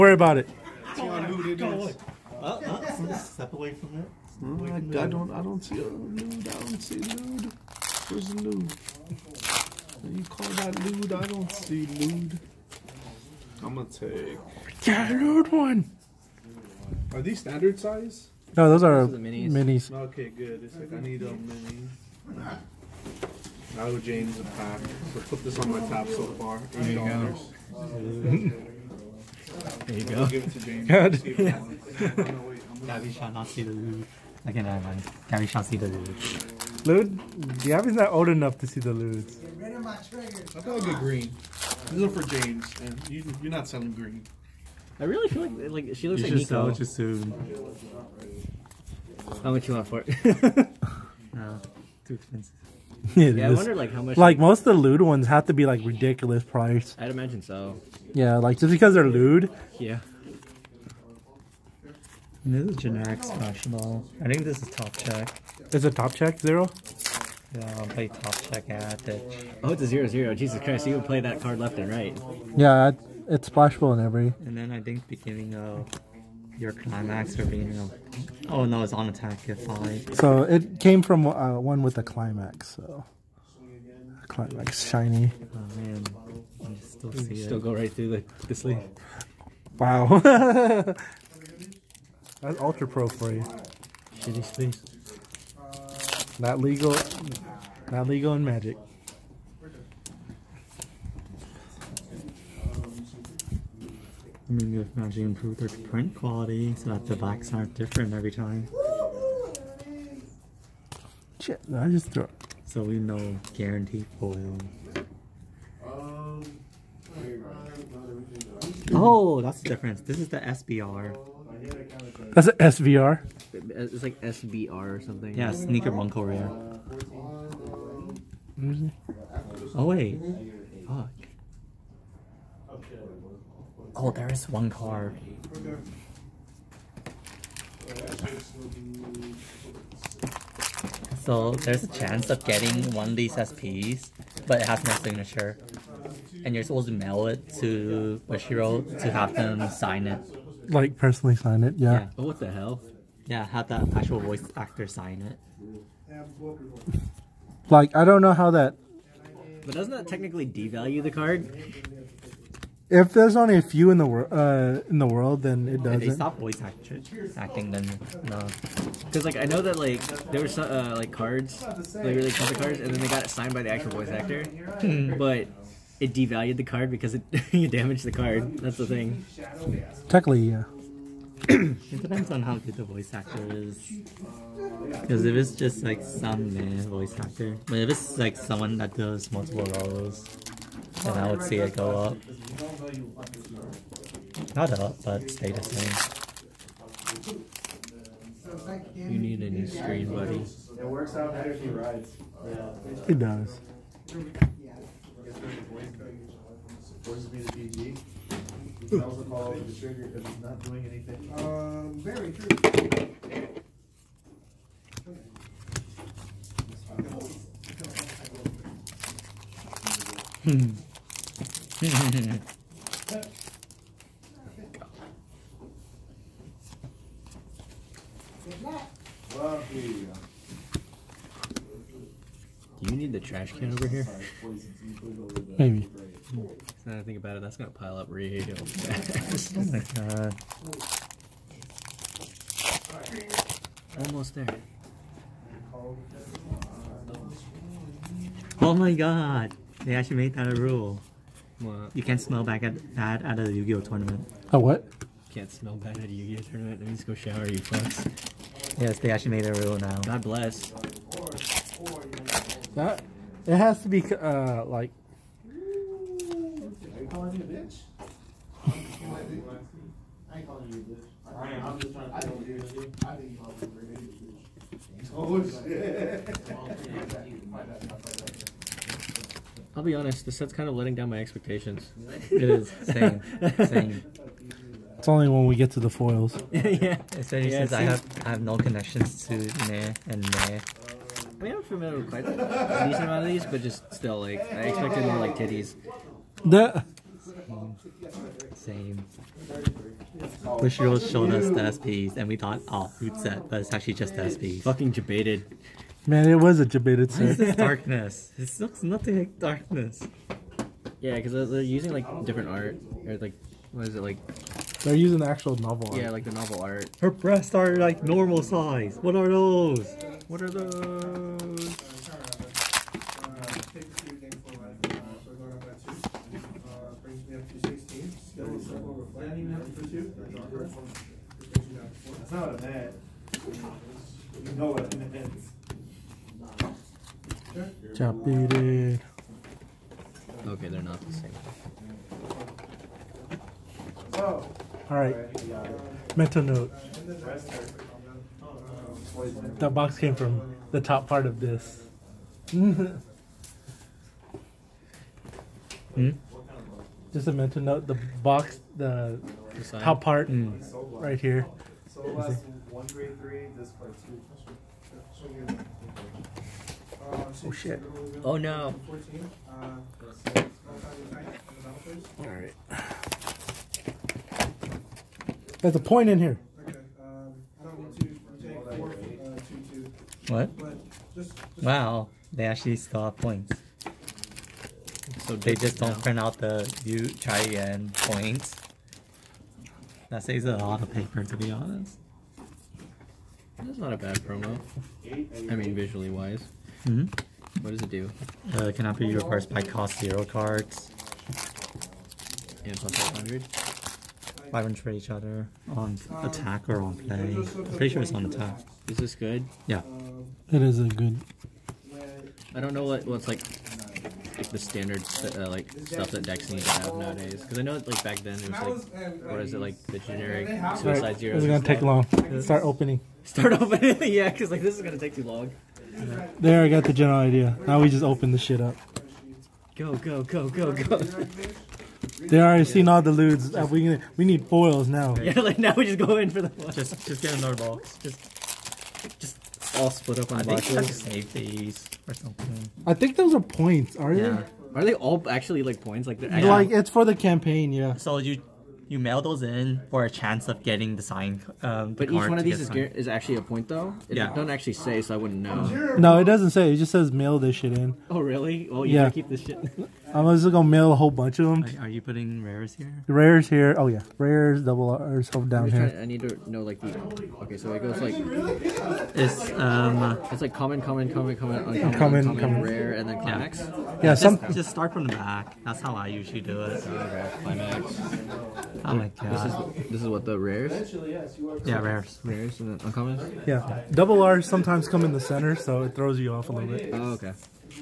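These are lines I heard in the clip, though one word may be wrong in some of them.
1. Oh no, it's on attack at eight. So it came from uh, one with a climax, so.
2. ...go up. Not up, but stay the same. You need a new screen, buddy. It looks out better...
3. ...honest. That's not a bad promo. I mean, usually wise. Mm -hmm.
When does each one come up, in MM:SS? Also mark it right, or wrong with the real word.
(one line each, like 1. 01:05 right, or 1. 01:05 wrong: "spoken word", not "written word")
1. 01:18 wrong: "five", not "eight"
2. 03:11 wrong: "works", not "looks"
3. 06:31 wrong: "visually", not "usually".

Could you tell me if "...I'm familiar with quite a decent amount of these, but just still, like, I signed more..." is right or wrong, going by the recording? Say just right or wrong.
wrong.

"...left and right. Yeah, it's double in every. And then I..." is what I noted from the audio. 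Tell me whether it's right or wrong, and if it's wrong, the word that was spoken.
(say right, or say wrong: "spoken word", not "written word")
wrong: "splashable", not "double".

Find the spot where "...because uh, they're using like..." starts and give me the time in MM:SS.
05:11.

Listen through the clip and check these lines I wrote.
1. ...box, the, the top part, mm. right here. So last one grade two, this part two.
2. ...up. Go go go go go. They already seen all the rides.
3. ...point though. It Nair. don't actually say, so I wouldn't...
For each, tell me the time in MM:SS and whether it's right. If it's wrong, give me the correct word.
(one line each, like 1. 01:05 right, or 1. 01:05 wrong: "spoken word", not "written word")
1. 05:58 wrong: "three", not "two"
2. 07:08 wrong: "ludes", not "rides"
3. 07:33 wrong: "Yeah", not "Nair".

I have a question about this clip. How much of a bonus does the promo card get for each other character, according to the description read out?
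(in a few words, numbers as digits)
plus 500.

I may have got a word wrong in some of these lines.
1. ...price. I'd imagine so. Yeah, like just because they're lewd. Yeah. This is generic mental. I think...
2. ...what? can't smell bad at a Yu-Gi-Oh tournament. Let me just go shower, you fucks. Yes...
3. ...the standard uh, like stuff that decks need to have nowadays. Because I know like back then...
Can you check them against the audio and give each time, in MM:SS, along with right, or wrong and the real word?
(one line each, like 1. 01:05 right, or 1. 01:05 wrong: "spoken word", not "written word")
1. 00:56 wrong: "special", not "mental"
2. 04:14 right
3. 06:54 right.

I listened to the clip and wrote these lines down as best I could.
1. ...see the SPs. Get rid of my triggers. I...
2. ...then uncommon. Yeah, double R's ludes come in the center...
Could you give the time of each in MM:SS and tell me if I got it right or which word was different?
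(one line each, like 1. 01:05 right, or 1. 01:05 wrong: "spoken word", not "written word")
1. 00:38 wrong: "Ludes", not "SPs"
2. 08:02 wrong: "sometimes", not "ludes".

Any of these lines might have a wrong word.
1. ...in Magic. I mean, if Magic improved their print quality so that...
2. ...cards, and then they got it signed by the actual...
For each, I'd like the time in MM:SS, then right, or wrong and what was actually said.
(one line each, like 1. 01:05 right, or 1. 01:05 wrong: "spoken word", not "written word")
1. 01:38 right
2. 02:52 right.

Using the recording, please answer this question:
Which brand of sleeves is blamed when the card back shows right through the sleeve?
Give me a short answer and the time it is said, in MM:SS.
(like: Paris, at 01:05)
Ultra Pro, at 01:32.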